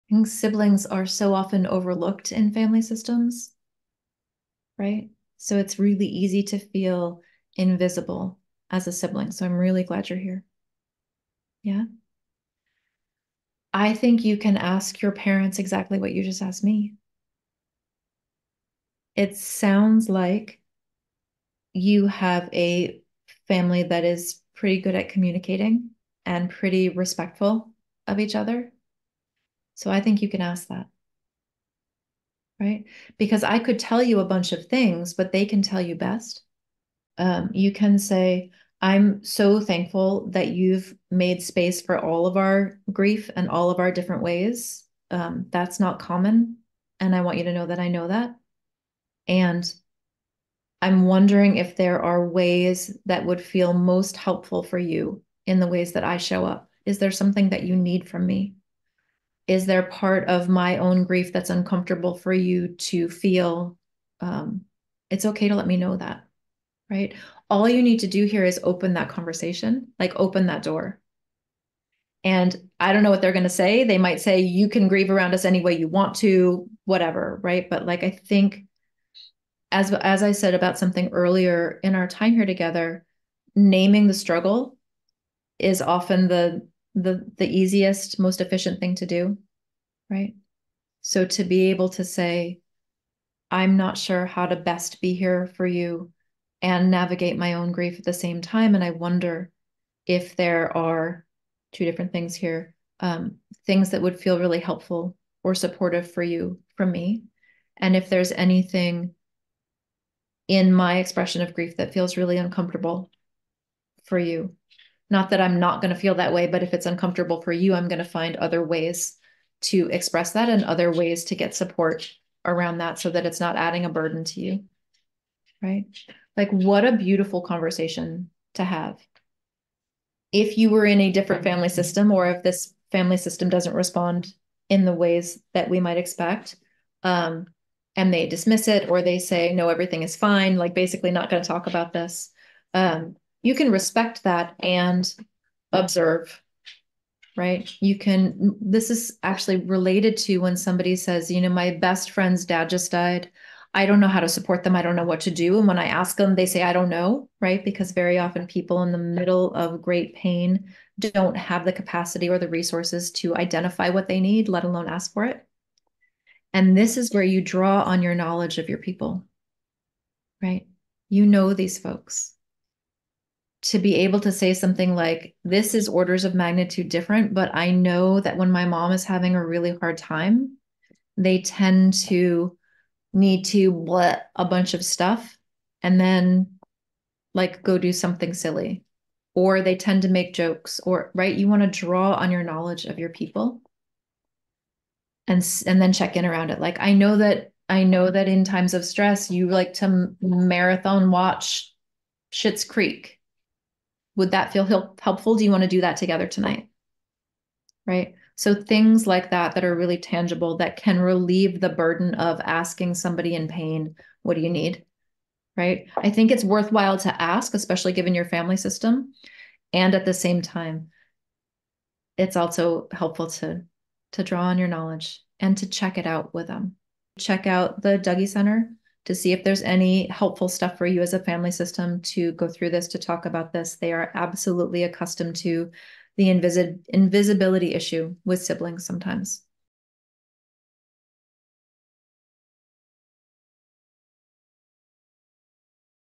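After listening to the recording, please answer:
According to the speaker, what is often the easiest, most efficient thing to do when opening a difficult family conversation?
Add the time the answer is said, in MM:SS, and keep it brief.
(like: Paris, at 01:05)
naming the struggle, at 01:23.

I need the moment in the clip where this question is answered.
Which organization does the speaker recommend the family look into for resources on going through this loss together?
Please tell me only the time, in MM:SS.
03:47.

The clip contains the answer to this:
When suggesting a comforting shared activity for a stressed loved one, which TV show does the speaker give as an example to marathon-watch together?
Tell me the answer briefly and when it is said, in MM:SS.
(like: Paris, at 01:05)
Schitt's Creek, at 03:22.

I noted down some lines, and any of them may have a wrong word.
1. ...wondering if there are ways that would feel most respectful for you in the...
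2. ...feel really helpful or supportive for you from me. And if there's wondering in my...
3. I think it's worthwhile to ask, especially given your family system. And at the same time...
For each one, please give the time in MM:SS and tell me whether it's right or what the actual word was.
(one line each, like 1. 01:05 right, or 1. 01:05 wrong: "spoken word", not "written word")
1. 00:51 wrong: "helpful", not "respectful"
2. 01:44 wrong: "anything", not "wondering"
3. 03:35 right.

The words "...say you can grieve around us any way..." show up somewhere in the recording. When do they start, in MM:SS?
01:14.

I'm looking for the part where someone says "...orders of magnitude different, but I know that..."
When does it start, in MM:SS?
02:55.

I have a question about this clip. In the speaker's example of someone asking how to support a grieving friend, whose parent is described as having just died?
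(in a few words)
best friend's dad.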